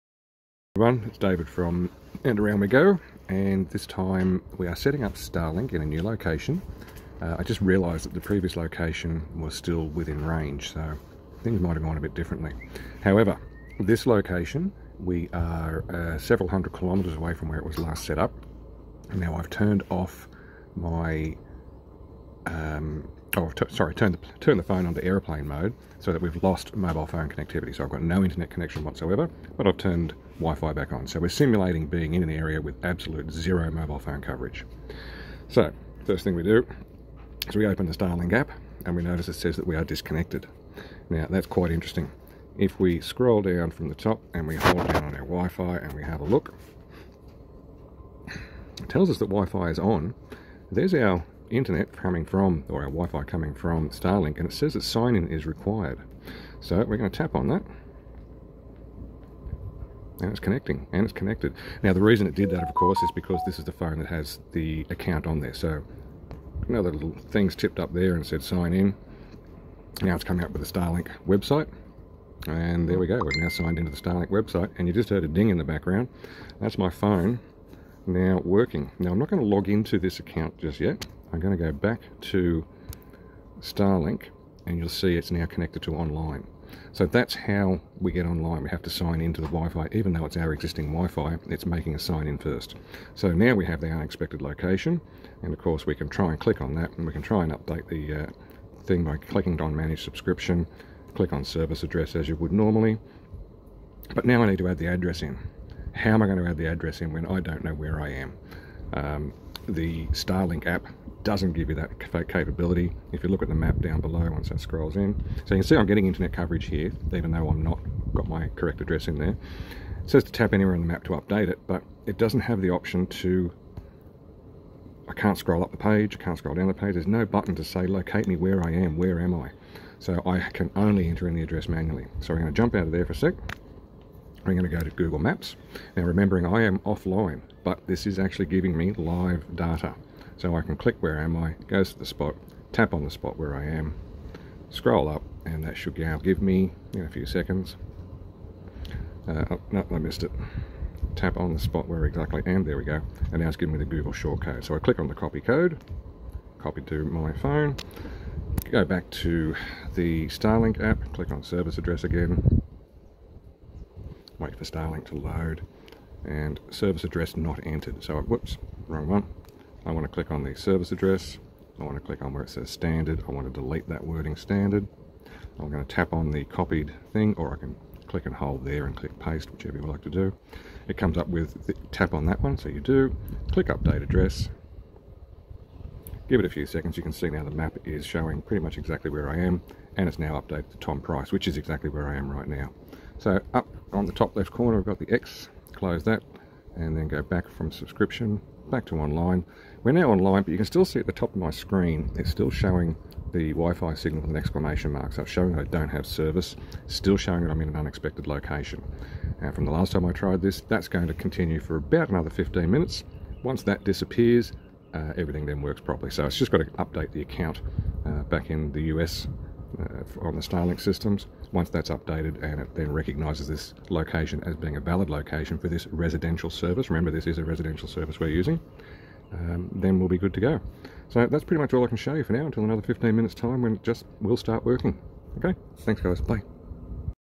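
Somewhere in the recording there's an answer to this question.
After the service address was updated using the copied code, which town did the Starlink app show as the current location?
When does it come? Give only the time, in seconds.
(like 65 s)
190 s.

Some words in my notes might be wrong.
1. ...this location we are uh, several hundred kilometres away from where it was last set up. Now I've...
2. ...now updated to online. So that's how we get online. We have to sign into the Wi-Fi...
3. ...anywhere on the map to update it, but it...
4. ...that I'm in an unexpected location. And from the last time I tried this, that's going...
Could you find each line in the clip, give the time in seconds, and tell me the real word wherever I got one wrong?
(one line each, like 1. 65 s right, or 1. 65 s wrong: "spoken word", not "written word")
1. 13 s right
2. 85 s wrong: "connected", not "updated"
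3. 120 s right
4. 207 s right.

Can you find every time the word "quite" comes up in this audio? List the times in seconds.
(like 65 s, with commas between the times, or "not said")
41 s.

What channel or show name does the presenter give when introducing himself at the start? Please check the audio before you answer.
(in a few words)
And Around We Go.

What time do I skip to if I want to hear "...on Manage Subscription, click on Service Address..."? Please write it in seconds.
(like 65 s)
99 s.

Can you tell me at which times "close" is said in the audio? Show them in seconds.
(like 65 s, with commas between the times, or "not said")
195 s.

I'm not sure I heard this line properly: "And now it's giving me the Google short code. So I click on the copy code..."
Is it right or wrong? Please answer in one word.
right.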